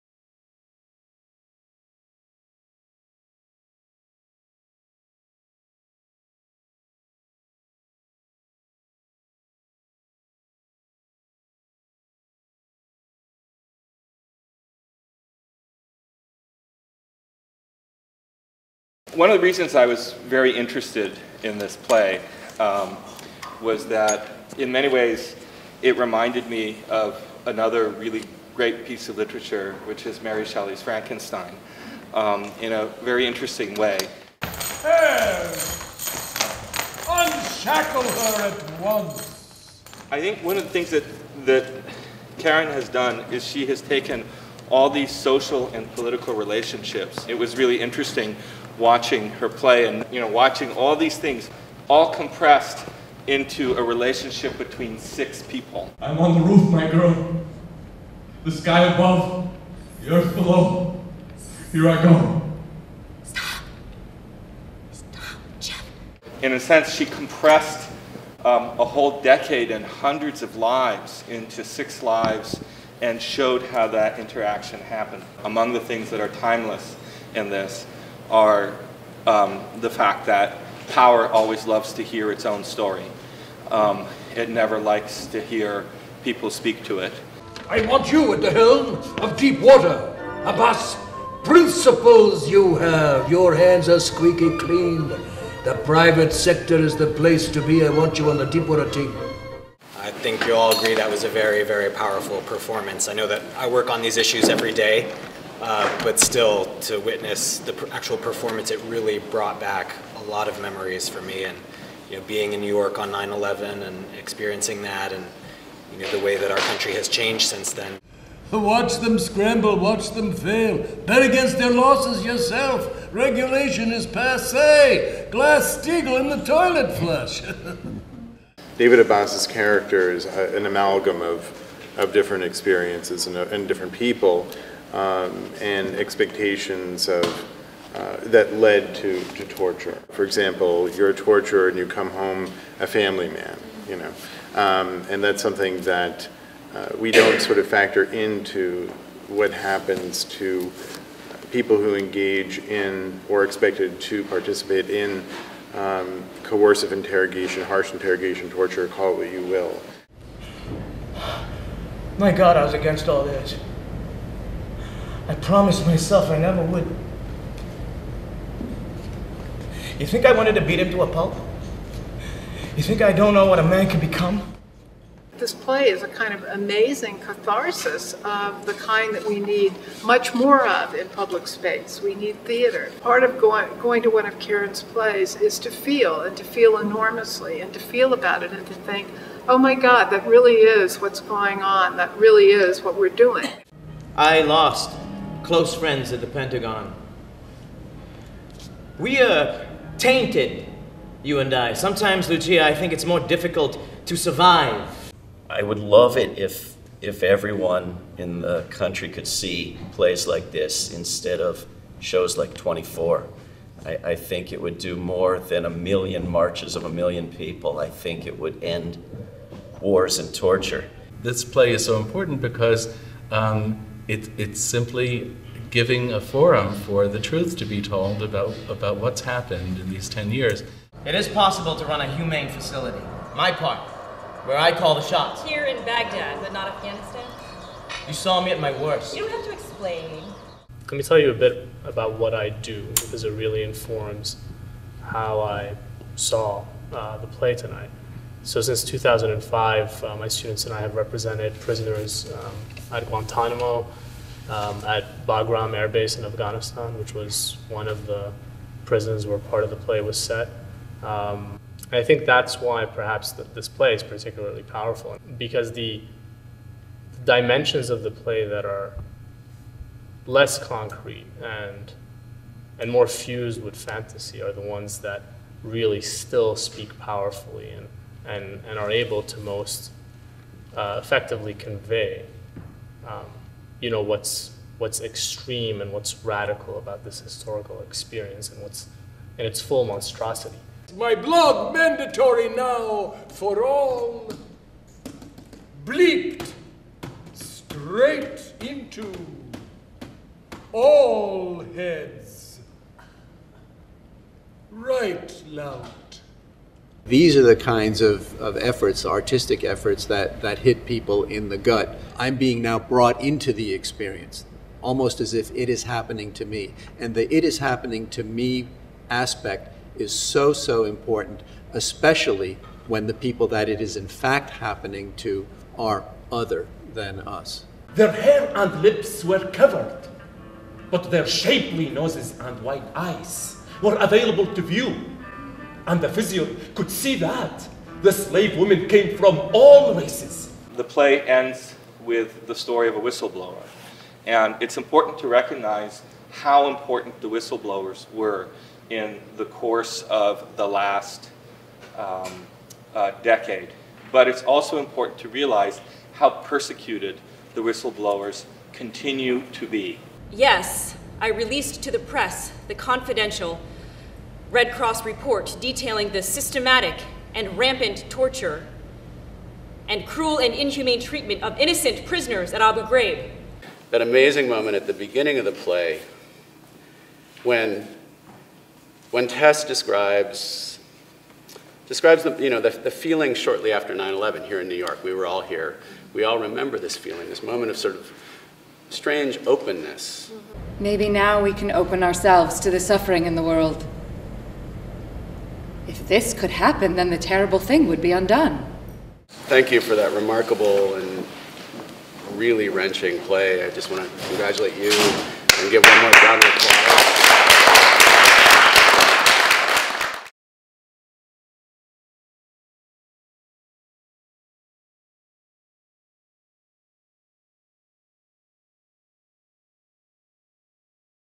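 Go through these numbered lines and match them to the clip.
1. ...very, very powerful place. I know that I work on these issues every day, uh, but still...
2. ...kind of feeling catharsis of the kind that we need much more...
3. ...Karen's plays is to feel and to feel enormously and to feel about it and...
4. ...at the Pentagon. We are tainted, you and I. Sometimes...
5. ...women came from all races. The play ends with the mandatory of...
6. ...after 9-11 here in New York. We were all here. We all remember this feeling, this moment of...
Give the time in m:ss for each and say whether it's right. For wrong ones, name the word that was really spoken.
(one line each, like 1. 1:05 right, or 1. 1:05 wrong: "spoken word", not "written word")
1. 1:41 wrong: "performance", not "place"
2. 2:56 wrong: "amazing", not "feeling"
3. 3:04 right
4. 3:16 right
5. 5:38 wrong: "story", not "mandatory"
6. 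6:23 right.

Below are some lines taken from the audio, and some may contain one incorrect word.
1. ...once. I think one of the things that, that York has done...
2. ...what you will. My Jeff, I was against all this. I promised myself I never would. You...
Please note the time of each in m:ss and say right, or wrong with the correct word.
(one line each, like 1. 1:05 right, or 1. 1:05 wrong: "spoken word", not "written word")
1. 0:38 wrong: "Karen", not "York"
2. 2:39 wrong: "God", not "Jeff".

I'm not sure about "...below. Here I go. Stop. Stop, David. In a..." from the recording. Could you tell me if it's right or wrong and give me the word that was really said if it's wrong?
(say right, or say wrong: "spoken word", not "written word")
wrong: "Jeff", not "David".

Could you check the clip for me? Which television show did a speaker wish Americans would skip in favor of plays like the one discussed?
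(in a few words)
24.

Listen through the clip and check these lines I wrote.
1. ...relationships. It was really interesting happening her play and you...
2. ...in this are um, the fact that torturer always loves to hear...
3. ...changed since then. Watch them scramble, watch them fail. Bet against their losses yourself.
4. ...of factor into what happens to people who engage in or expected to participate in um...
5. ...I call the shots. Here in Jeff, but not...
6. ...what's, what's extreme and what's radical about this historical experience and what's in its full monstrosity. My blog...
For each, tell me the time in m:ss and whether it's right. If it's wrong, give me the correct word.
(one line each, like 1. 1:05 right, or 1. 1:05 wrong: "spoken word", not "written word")
1. 0:46 wrong: "watching", not "happening"
2. 1:17 wrong: "power", not "torturer"
3. 1:57 right
4. 2:27 right
5. 3:54 wrong: "Baghdad", not "Jeff"
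6. 4:44 right.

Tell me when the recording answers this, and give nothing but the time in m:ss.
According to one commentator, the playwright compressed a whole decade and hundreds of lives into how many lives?
1:11.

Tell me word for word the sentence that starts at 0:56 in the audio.
I'm on the roof, my girl.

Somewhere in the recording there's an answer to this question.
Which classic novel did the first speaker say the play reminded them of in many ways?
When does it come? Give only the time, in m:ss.
0:30.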